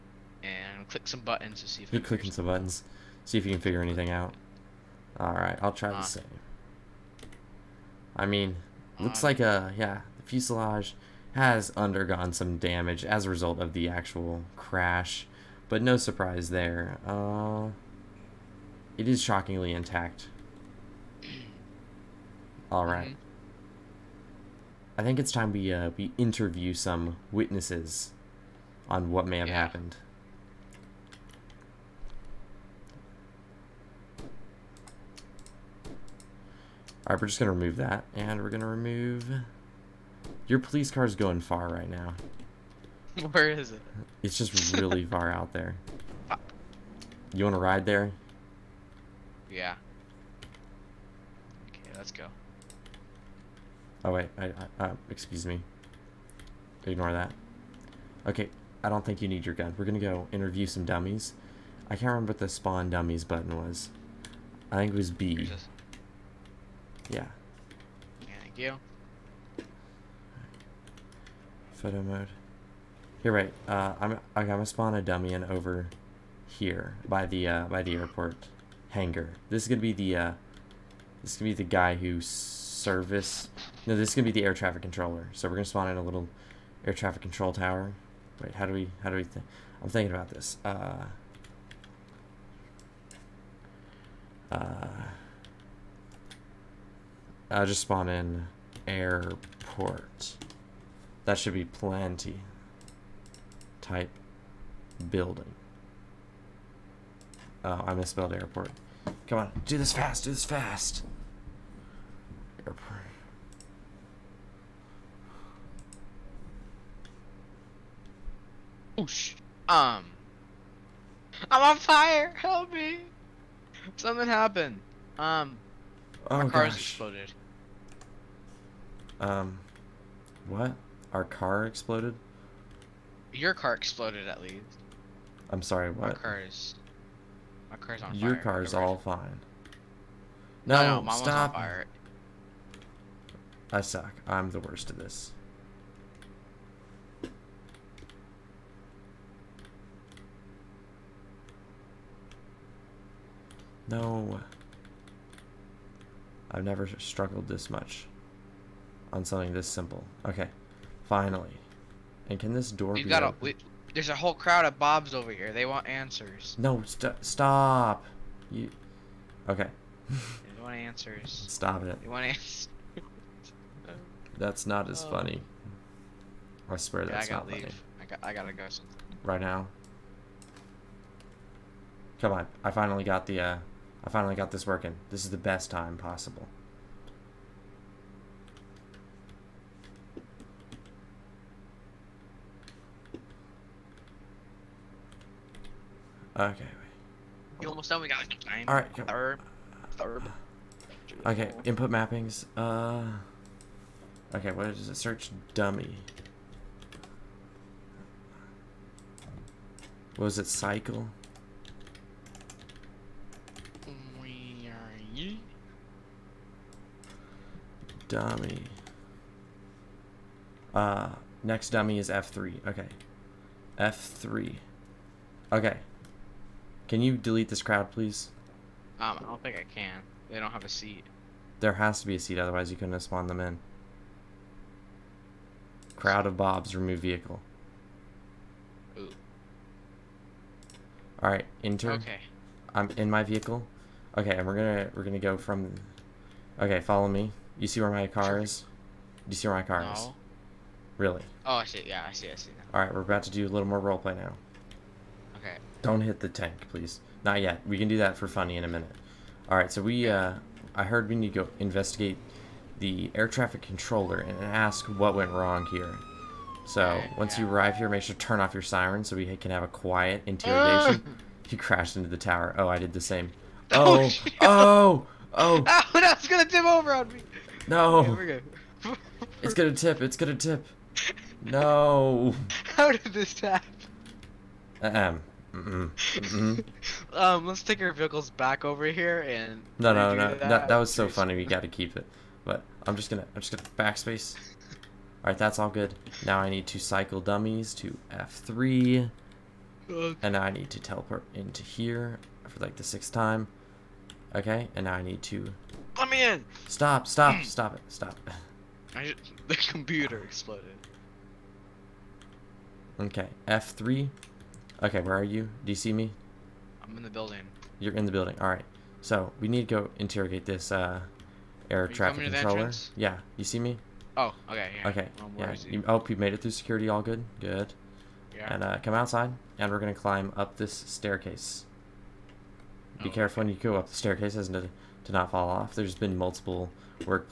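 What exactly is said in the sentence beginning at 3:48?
Um, I don't think I can.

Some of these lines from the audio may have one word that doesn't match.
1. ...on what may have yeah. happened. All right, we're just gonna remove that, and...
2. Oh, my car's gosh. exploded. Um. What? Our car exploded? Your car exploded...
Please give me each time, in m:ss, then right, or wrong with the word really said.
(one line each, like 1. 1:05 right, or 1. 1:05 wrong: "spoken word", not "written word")
1. 0:28 right
2. 2:06 right.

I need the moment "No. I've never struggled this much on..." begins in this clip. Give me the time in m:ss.
2:33.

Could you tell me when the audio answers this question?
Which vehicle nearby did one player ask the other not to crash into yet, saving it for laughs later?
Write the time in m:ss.
4:16.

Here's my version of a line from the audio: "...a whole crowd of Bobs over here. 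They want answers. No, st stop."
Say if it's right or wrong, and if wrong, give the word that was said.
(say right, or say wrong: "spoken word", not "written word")
right.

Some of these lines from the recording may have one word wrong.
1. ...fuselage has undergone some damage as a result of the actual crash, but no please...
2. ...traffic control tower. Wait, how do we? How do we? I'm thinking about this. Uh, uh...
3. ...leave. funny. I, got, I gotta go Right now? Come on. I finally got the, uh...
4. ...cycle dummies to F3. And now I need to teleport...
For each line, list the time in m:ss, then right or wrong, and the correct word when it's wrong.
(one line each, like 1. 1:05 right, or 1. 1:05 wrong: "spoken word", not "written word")
1. 0:10 wrong: "surprise", not "please"
2. 1:26 right
3. 2:57 right
4. 4:56 right.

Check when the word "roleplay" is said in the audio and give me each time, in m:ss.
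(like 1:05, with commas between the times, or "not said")
4:13.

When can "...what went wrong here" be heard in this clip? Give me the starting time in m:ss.
4:24.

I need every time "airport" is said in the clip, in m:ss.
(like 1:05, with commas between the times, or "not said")
1:17, 1:38, 1:48.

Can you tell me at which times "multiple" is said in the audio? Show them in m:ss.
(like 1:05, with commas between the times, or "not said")
5:36.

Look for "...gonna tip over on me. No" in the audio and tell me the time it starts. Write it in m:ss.
4:36.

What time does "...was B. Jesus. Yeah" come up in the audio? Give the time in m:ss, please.
1:04.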